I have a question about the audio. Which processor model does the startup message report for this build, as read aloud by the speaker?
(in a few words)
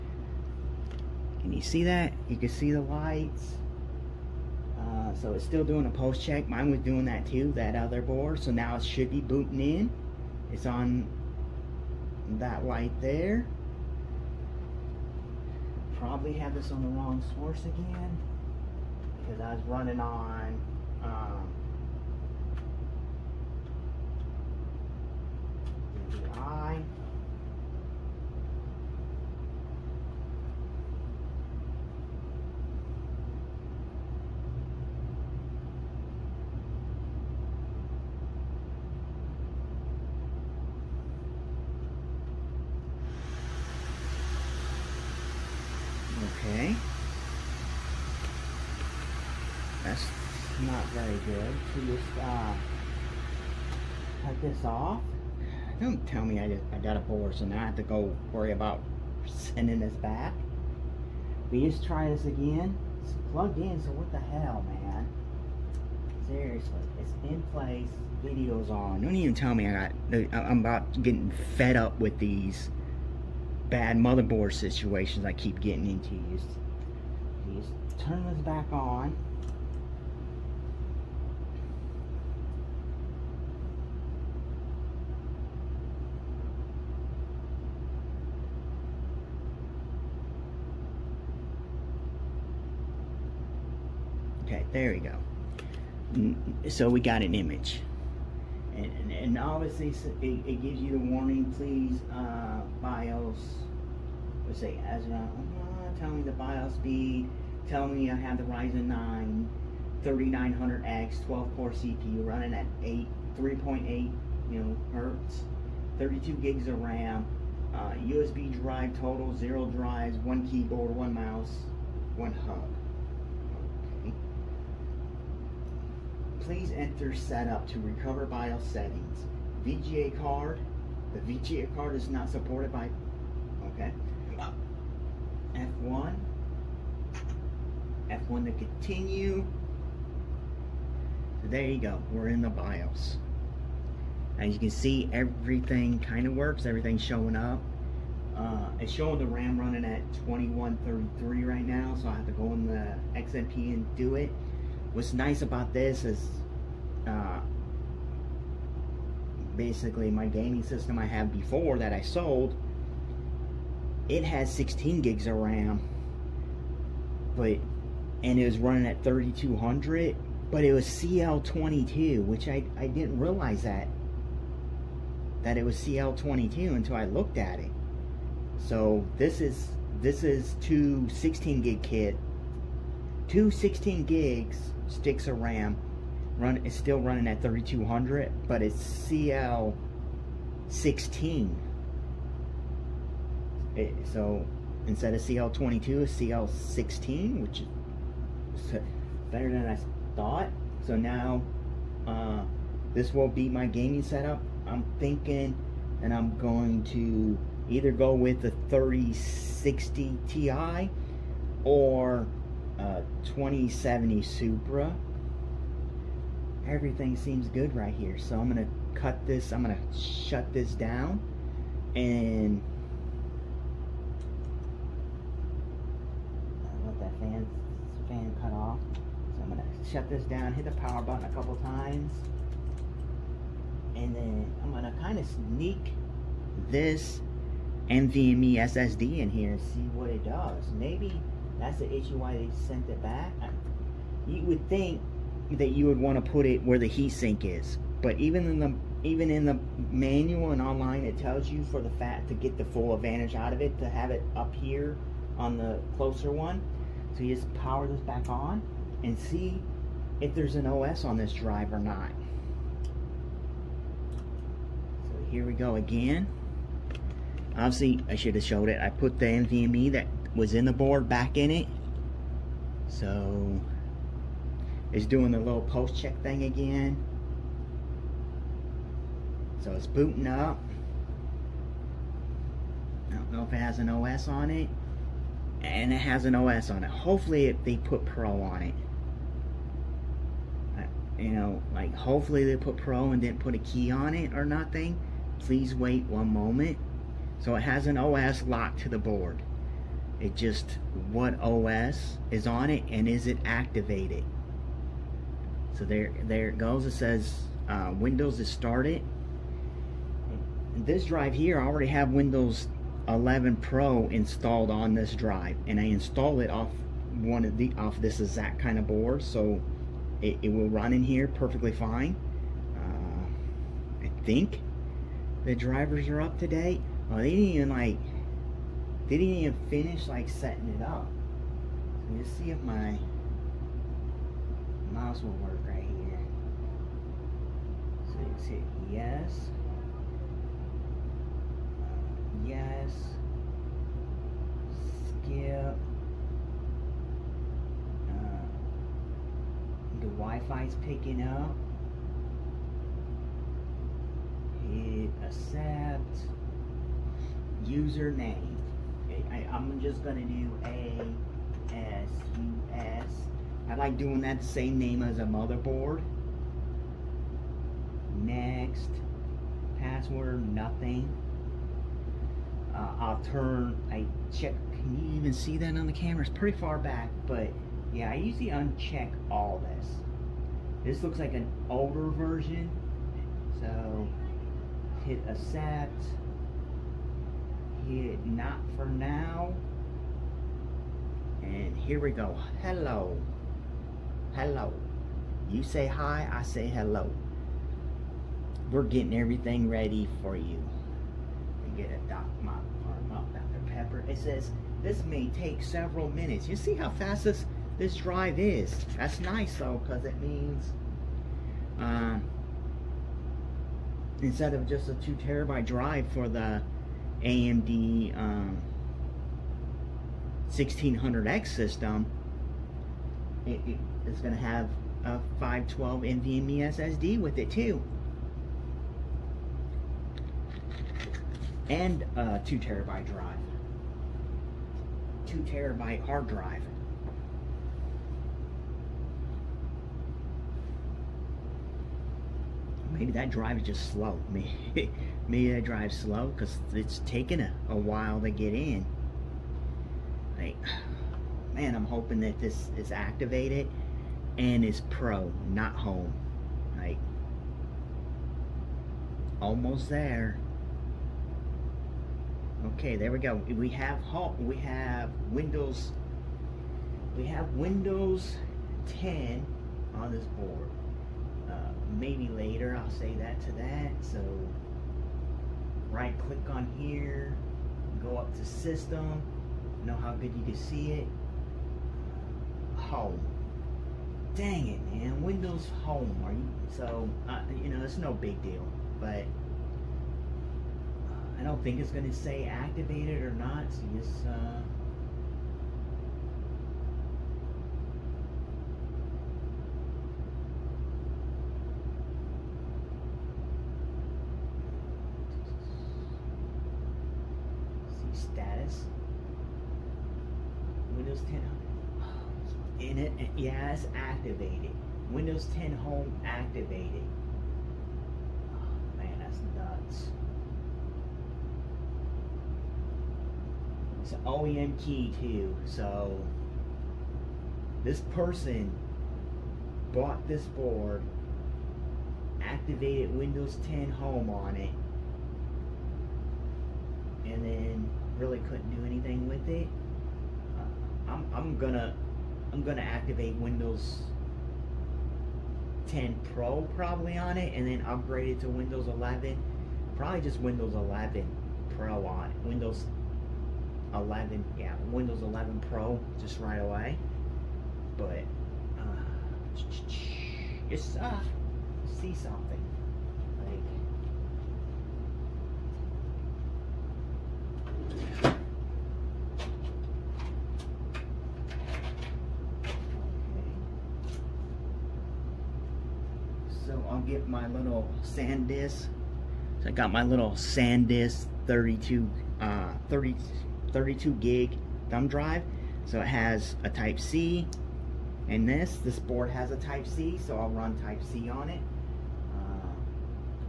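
Ryzen 9 3900X.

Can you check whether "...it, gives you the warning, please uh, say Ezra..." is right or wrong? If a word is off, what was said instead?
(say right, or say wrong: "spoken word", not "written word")
right.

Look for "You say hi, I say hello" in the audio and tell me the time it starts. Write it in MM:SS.
06:35.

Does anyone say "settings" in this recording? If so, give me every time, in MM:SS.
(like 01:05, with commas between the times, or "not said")
02:08, 05:30.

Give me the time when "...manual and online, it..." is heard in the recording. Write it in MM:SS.
04:09.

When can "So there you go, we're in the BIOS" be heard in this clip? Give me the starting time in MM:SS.
02:21.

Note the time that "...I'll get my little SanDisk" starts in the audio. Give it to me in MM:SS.
09:36.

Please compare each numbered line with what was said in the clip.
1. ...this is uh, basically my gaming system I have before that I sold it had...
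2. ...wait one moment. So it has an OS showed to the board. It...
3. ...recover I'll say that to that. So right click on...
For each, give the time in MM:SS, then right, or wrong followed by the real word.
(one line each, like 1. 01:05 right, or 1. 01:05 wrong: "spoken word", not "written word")
1. 02:35 right
2. 04:55 wrong: "locked", not "showed"
3. 07:52 wrong: "later", not "recover".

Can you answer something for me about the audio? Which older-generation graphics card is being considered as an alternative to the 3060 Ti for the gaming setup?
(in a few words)
2070 Super.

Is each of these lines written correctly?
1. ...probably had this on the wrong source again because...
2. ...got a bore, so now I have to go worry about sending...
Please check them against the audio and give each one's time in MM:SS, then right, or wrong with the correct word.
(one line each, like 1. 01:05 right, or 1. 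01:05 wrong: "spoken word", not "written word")
1. 00:15 right
2. 00:56 right.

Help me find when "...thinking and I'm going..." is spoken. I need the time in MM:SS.
03:24.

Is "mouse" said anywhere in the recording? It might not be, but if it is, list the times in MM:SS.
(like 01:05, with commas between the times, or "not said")
02:01, 05:34.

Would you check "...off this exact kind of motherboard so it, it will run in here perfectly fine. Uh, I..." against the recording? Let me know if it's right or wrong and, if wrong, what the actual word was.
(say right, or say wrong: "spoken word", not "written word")
wrong: "board", not "motherboard".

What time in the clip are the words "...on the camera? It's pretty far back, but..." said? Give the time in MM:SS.
06:15.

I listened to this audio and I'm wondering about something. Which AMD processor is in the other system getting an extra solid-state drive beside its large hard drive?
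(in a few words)
AMD 1600X.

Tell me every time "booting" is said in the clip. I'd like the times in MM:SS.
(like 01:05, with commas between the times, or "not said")
00:09, 04:39.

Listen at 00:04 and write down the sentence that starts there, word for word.
Uh, so it's still doing a post check.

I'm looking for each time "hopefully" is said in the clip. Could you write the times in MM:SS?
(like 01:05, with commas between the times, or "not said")
04:46, 04:51.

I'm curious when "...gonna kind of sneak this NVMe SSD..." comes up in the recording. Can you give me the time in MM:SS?
03:54.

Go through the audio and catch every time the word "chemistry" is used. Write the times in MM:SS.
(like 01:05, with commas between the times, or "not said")
not said.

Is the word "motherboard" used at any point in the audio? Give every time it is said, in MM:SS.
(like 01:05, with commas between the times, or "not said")
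01:13, 06:05.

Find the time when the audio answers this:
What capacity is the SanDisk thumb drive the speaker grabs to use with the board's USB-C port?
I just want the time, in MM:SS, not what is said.
09:43.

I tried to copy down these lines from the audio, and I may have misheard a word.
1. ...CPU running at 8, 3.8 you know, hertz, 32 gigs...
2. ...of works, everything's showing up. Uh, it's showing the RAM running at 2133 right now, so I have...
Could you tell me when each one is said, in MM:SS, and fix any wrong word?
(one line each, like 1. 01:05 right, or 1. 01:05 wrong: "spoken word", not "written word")
1. 01:51 right
2. 02:26 right.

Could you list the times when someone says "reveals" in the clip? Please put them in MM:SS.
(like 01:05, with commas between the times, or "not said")
not said.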